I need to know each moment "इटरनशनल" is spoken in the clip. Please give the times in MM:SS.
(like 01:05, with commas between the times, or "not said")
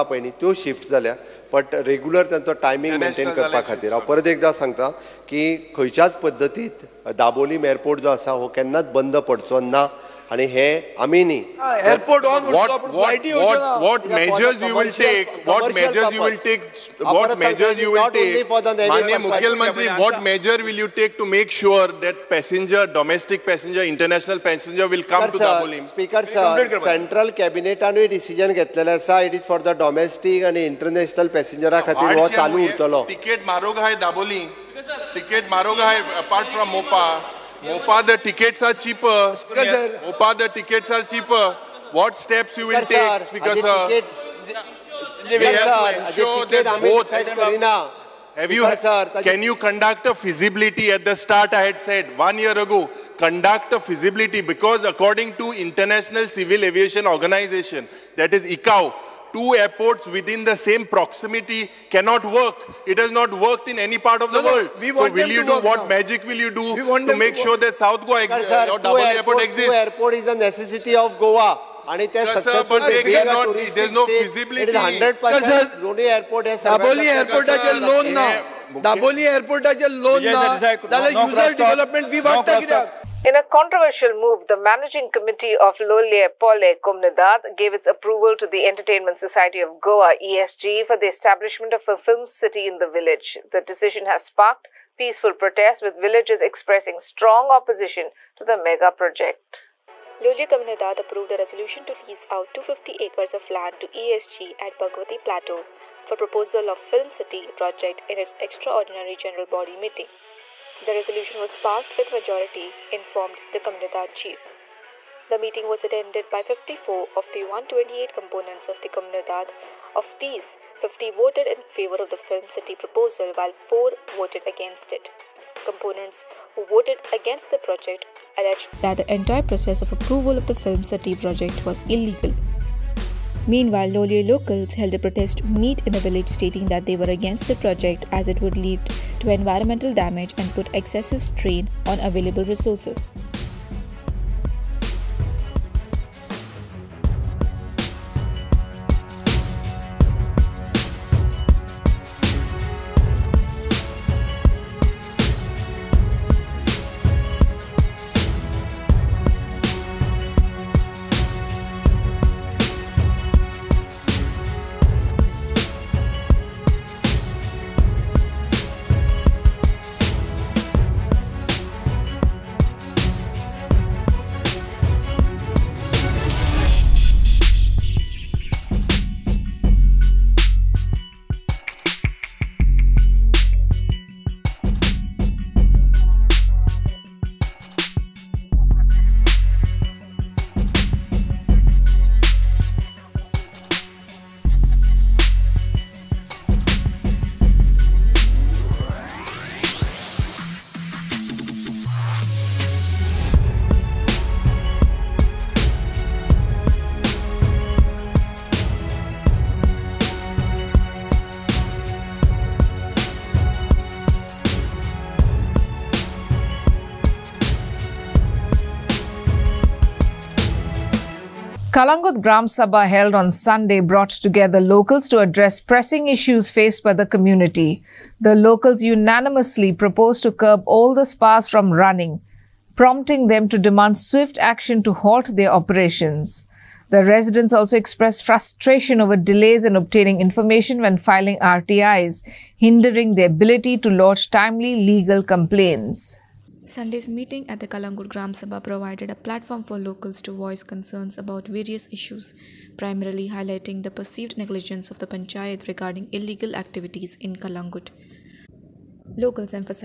00:23, 00:30.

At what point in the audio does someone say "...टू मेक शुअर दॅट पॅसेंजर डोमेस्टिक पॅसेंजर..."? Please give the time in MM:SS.
00:21.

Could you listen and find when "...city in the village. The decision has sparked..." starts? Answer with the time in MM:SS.
01:32.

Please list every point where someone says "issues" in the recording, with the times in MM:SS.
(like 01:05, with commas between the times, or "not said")
03:46, 04:11.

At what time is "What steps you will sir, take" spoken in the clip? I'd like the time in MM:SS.
00:41.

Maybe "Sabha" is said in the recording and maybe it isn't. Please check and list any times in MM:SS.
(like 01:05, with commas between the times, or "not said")
03:42, 04:08.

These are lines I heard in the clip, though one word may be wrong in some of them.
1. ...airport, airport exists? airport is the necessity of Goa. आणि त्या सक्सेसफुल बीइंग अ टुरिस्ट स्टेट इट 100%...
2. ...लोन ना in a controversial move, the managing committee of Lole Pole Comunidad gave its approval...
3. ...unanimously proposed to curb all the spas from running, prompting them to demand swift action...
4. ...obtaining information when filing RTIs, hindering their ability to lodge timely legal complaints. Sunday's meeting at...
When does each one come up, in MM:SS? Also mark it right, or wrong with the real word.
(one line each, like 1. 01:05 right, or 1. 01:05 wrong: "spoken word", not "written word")
1. 01:08 right
2. 01:17 right
3. 03:48 right
4. 03:59 right.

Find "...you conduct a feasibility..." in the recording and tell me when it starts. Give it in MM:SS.
00:49.